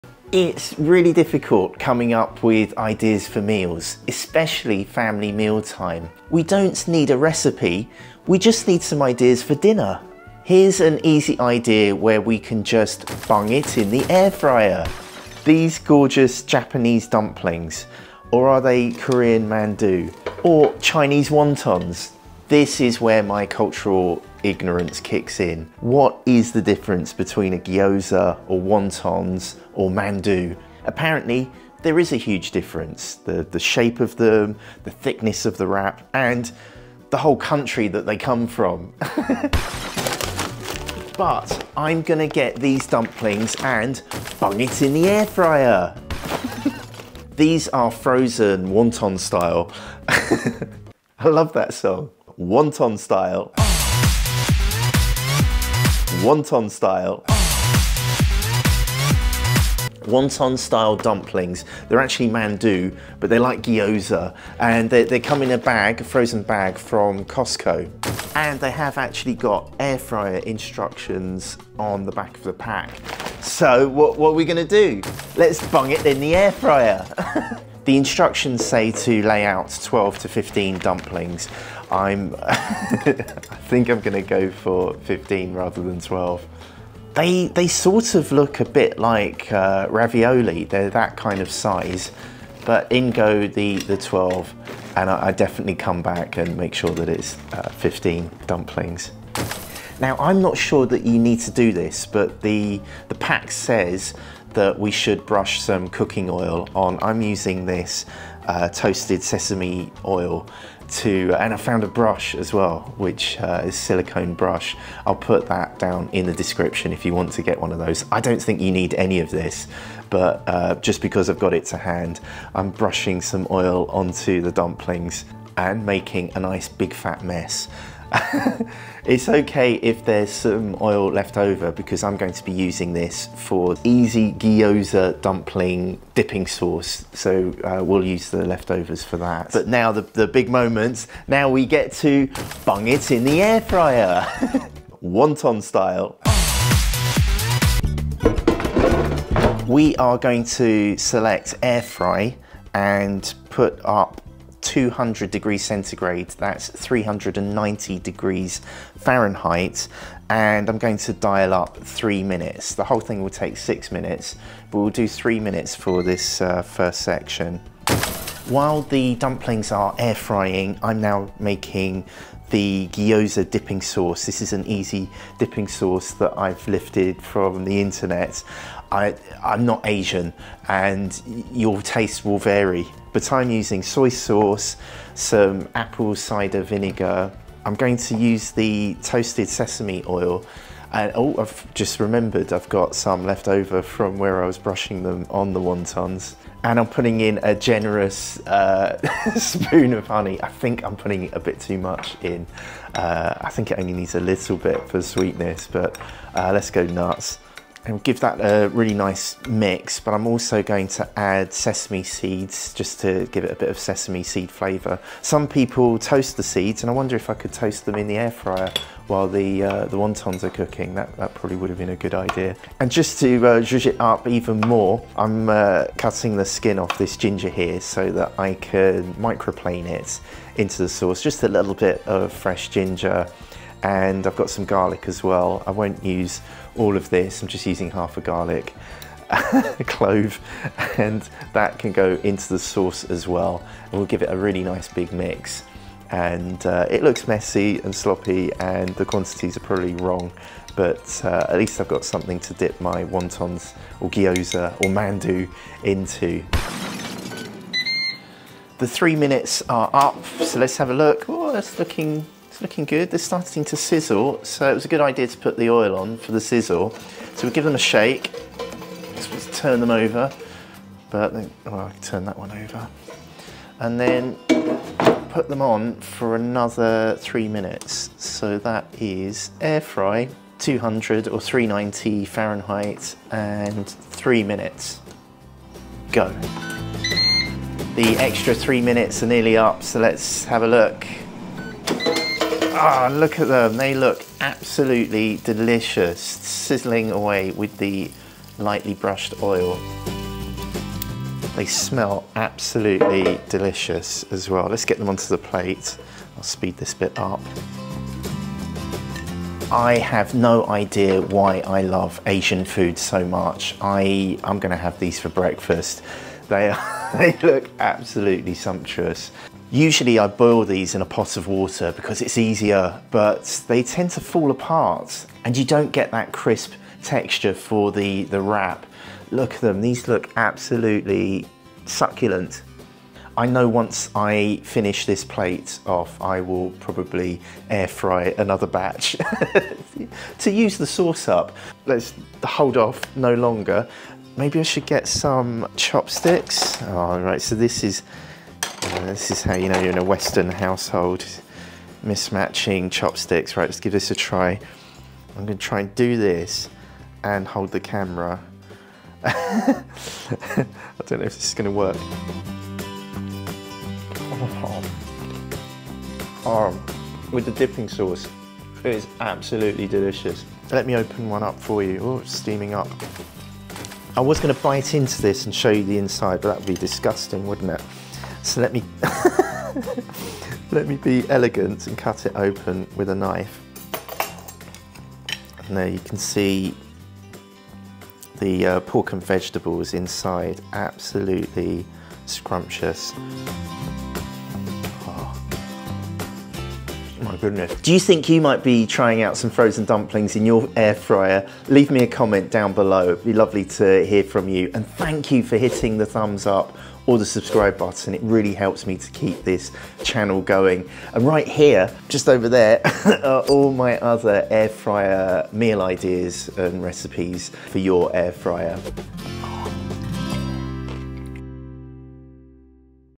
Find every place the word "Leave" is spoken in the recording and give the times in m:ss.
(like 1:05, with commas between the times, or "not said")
6:41.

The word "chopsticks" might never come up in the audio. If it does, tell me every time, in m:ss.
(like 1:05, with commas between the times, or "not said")
5:45, 5:52.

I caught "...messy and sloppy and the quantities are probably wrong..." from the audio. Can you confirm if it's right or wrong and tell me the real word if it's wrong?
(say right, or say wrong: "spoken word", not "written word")
right.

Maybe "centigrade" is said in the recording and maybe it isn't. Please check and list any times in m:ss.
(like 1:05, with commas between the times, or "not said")
2:35.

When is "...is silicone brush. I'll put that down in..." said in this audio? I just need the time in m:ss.
1:53.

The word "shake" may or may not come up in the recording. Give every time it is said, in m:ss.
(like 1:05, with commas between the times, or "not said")
4:27.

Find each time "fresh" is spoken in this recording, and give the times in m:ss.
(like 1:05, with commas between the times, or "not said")
3:52.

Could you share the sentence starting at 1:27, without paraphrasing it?
They, they sort of look a bit like uh, ravioli.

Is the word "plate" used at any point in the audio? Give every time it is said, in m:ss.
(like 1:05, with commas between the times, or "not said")
5:05, 5:35.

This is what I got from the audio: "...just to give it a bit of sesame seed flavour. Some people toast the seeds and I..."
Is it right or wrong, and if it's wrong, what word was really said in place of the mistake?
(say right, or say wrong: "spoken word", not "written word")
right.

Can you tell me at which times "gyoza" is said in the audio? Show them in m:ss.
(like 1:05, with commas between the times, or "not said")
0:27, 1:03, 2:14, 2:52, 4:14.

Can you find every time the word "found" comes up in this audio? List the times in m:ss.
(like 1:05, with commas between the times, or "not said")
1:51.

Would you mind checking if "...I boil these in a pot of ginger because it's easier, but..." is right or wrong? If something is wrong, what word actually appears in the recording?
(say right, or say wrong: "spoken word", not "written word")
wrong: "water", not "ginger".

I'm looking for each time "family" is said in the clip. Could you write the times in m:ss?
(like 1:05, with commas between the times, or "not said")
0:04.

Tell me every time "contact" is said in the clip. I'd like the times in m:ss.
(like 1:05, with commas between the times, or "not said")
not said.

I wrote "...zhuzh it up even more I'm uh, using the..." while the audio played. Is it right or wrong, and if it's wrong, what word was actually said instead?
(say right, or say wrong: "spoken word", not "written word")
wrong: "cutting", not "using".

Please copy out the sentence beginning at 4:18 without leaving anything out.
The three minutes are up so let's have a look.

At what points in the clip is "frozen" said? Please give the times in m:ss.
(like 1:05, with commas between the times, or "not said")
0:47, 1:06, 6:39.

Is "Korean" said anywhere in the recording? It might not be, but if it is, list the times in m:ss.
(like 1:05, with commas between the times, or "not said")
0:18.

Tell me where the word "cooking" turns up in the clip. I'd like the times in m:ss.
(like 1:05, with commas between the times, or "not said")
1:45, 3:40.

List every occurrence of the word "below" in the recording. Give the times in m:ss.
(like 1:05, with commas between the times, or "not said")
6:42.